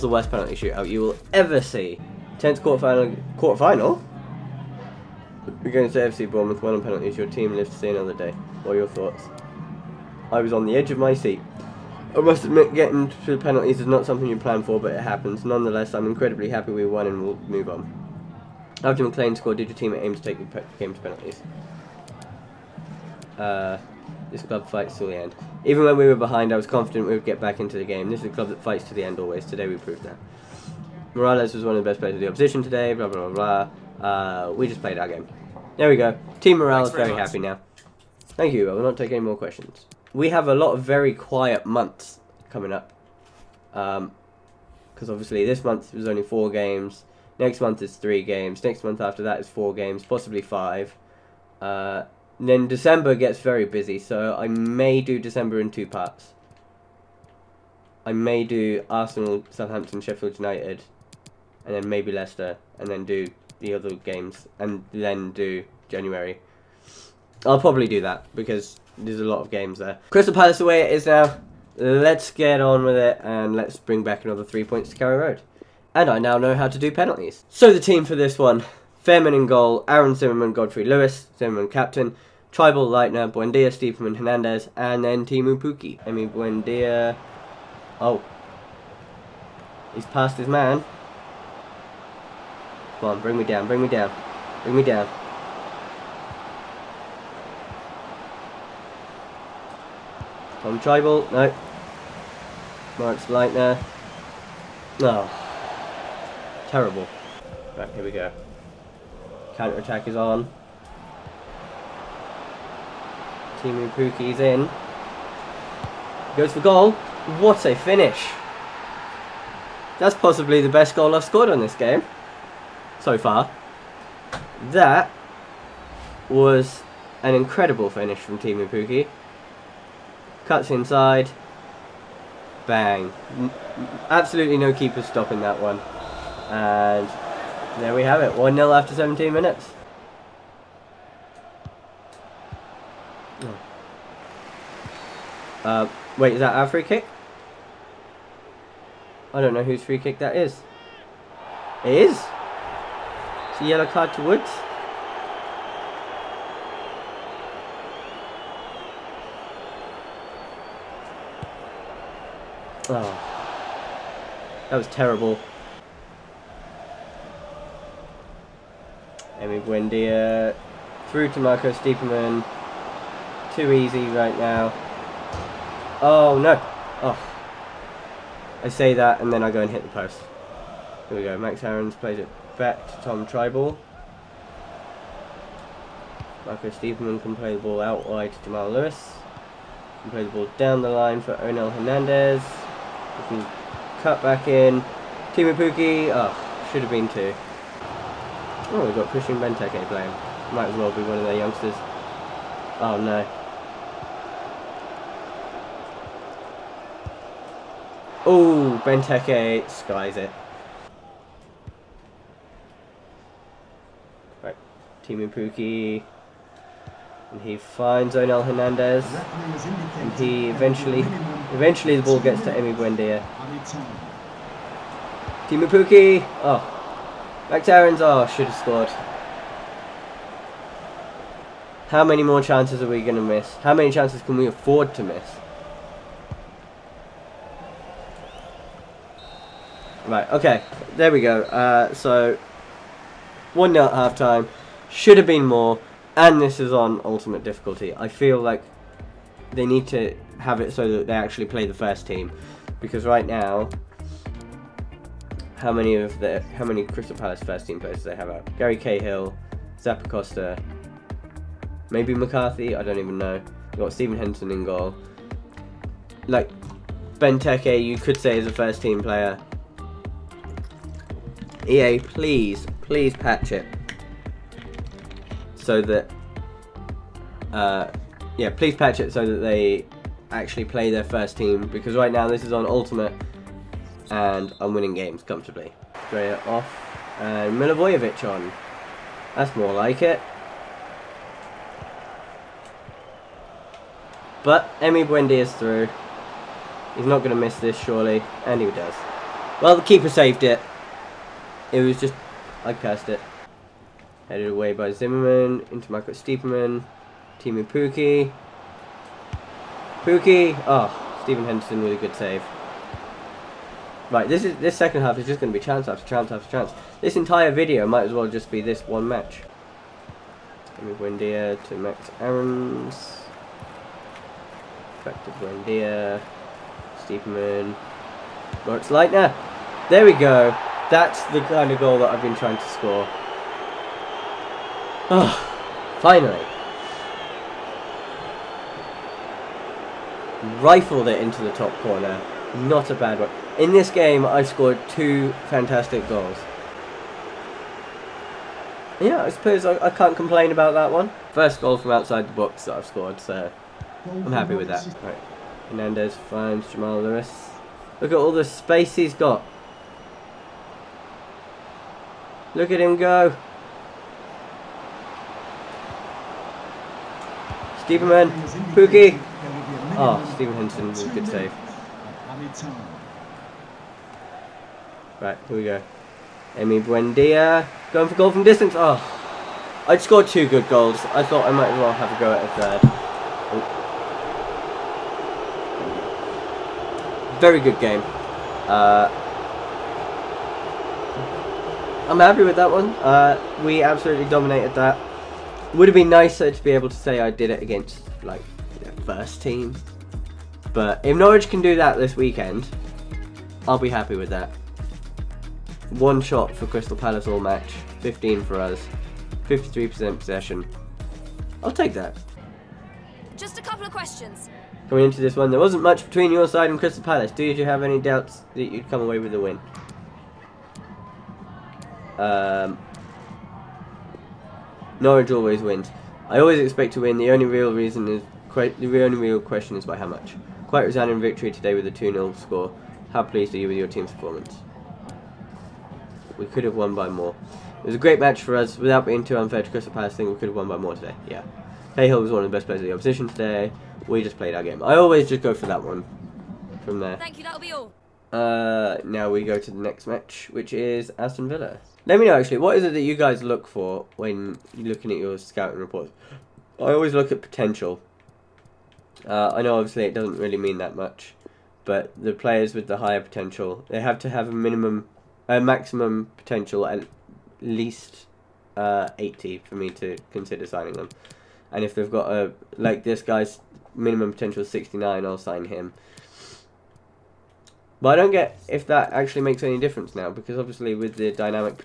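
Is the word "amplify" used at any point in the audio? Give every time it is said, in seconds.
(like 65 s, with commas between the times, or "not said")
not said.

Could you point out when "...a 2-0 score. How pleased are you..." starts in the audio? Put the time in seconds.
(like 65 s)
431 s.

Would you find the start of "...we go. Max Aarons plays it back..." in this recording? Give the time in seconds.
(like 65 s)
181 s.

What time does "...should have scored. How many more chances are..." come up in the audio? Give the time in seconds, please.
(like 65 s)
228 s.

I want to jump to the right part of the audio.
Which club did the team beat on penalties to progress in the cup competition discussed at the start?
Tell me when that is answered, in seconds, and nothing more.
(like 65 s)
5 s.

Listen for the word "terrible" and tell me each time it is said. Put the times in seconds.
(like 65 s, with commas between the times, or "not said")
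106 s, 164 s.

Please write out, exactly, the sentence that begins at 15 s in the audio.
Nonetheless, I'm incredibly happy we won and we'll move on.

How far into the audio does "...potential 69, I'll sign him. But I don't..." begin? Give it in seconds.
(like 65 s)
474 s.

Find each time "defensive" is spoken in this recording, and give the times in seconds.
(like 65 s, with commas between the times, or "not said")
not said.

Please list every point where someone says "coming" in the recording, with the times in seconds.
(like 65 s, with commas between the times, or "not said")
42 s, 414 s.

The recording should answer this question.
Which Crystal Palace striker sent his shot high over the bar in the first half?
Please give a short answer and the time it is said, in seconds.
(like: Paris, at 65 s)
Christian Benteke, at 199 s.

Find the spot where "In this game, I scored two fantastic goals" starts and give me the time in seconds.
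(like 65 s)
343 s.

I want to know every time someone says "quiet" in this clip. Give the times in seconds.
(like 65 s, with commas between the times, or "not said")
41 s.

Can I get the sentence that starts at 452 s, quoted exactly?
Let me know, actually, what is it that you guys look for when looking at your scouting reports?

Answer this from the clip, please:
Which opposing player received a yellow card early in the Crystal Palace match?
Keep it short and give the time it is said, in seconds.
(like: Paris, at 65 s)
Woods, at 154 s.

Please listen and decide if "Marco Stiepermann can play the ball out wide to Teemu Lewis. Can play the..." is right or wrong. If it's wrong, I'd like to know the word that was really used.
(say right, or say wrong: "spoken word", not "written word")
wrong: "Jamal", not "Teemu".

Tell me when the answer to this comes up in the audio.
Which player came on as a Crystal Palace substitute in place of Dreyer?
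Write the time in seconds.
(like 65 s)
287 s.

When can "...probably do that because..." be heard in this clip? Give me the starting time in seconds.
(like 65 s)
67 s.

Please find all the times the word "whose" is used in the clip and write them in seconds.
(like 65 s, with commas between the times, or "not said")
149 s.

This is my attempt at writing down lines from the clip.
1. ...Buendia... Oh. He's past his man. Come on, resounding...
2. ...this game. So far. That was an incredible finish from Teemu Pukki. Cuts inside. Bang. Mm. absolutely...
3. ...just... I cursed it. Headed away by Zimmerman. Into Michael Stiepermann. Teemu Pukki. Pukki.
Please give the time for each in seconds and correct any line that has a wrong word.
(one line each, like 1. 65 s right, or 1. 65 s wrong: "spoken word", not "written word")
1. 86 s wrong: "bring", not "resounding"
2. 121 s right
3. 301 s right.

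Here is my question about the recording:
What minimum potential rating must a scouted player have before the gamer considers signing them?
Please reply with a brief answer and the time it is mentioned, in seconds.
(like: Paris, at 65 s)
80, at 469 s.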